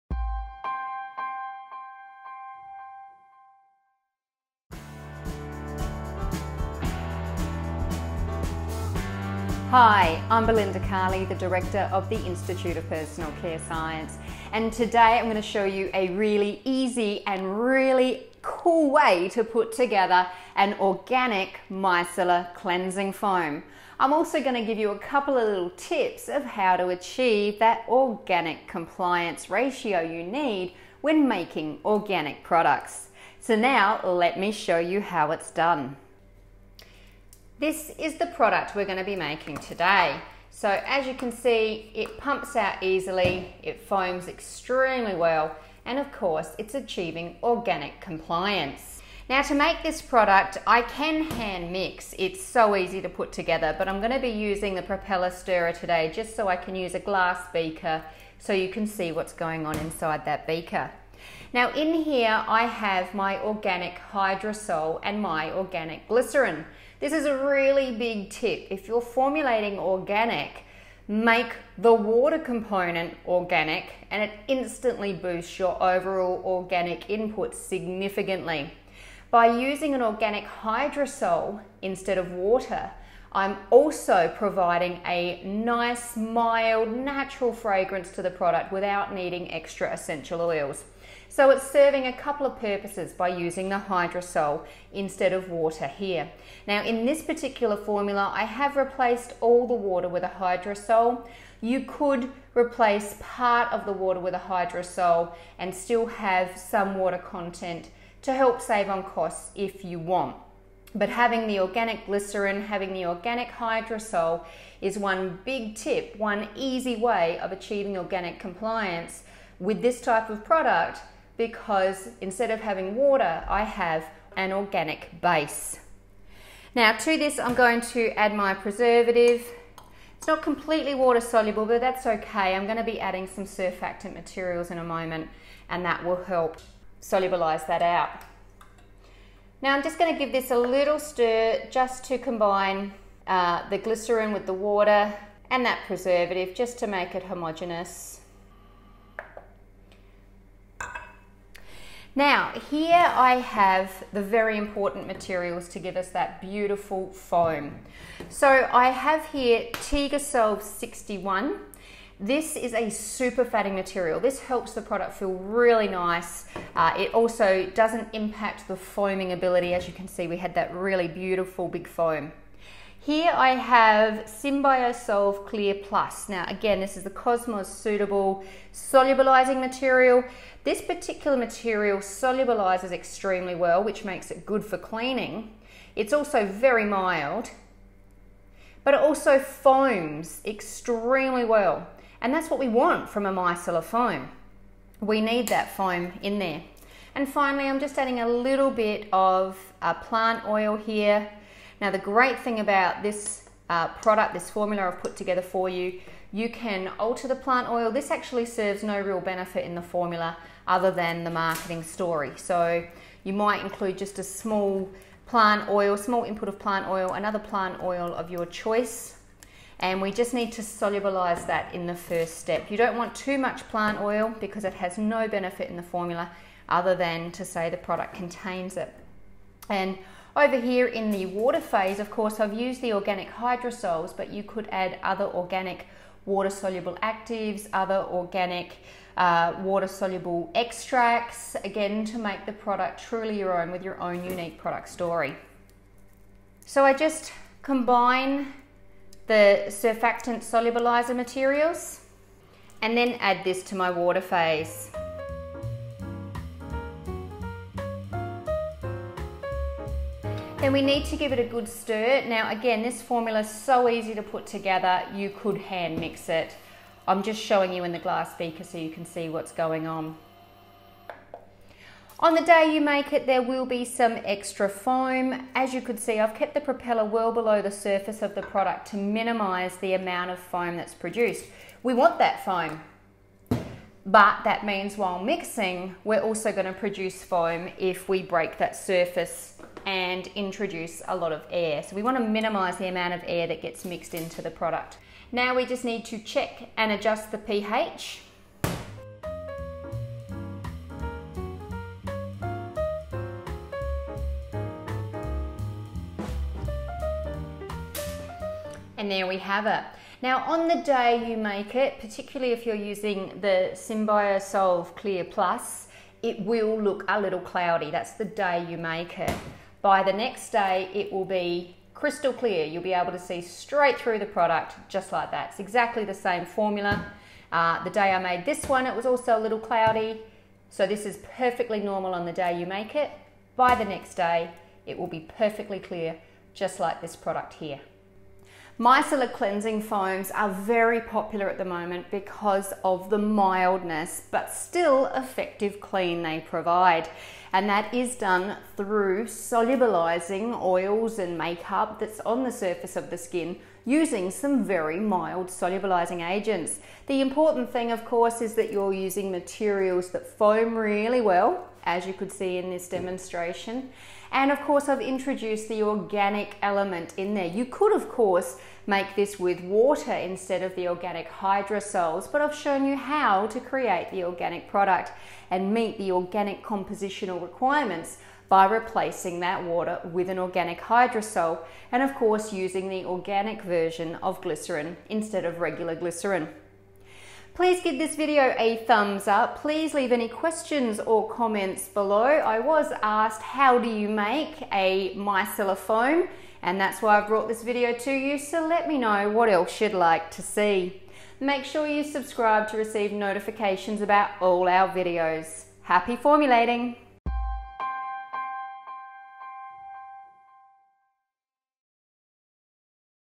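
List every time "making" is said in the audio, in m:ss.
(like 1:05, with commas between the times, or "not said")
0:31, 0:39.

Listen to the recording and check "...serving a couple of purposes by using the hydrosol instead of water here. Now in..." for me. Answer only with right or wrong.
right.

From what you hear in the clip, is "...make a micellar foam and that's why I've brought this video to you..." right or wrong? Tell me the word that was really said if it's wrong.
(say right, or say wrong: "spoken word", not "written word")
right.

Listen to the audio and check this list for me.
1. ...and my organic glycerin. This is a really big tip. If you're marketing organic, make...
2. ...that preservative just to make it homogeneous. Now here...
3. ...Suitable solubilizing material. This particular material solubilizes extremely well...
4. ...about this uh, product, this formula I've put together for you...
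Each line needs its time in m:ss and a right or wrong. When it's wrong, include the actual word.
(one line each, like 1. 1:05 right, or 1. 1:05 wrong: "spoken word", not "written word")
1. 1:05 wrong: "formulating", not "marketing"
2. 2:25 right
3. 2:57 right
4. 3:22 right.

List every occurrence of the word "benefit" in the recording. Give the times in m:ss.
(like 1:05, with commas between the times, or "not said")
3:29, 3:45.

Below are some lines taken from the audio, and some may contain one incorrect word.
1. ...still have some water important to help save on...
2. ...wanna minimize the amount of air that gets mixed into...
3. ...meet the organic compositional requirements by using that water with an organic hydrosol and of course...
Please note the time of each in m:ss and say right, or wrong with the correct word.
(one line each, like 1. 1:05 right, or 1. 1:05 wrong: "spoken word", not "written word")
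1. 1:45 wrong: "content", not "important"
2. 4:52 right
3. 6:15 wrong: "replacing", not "using".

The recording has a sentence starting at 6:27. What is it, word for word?
Please give this video a thumbs up.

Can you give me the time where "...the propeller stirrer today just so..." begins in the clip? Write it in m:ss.
0:54.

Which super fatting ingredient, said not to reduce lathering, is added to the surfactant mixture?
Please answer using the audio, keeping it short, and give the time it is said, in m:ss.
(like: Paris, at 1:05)
Tegosolve 61, at 2:39.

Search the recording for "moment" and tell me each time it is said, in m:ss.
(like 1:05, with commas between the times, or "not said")
2:14, 5:41.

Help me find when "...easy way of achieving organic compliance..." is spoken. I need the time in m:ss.
1:56.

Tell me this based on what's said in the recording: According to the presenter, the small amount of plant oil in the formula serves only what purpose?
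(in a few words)
the marketing story.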